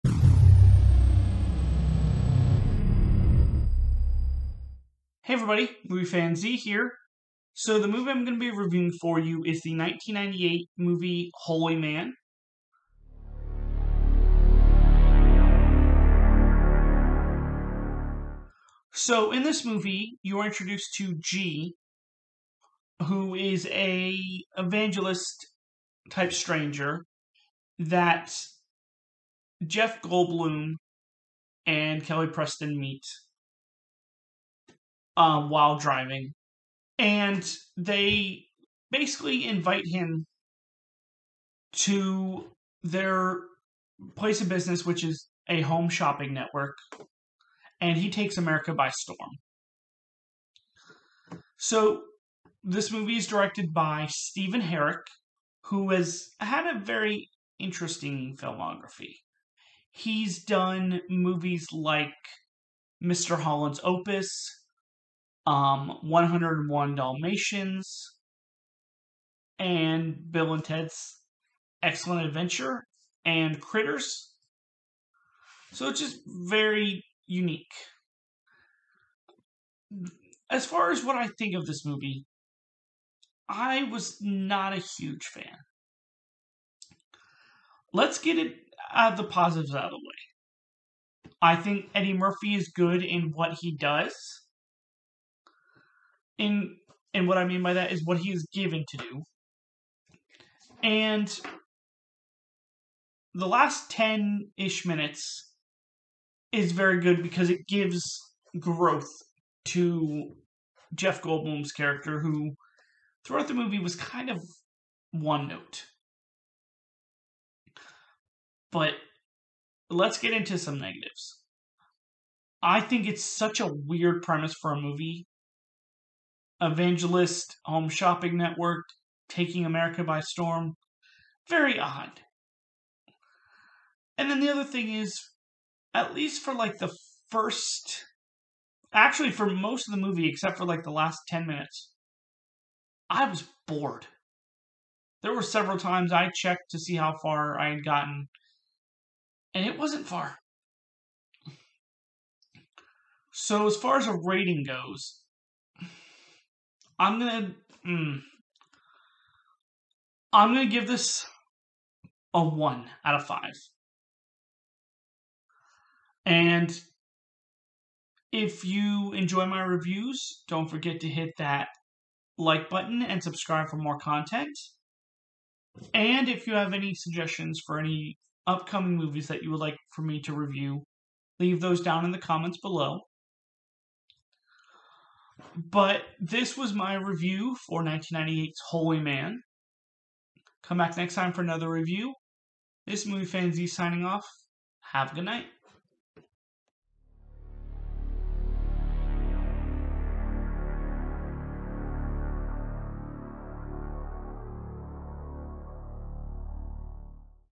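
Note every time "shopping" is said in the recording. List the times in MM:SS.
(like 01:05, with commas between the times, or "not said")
00:45, 02:07.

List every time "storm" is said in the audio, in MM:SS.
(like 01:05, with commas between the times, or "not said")
00:48, 02:10.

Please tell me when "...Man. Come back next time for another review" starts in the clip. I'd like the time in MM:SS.
03:09.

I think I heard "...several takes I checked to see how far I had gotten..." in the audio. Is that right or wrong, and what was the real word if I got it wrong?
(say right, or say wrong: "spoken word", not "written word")
wrong: "times", not "takes".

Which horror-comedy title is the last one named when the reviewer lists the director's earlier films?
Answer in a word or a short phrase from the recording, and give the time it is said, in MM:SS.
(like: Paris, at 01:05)
Critters, at 01:13.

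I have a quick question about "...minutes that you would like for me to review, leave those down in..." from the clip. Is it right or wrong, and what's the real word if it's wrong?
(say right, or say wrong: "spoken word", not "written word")
wrong: "movies", not "minutes".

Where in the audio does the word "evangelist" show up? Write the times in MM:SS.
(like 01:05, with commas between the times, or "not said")
00:24, 02:06.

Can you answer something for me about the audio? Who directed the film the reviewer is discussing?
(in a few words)
Stephen Herek.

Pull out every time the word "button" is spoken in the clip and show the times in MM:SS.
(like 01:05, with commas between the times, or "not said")
02:52.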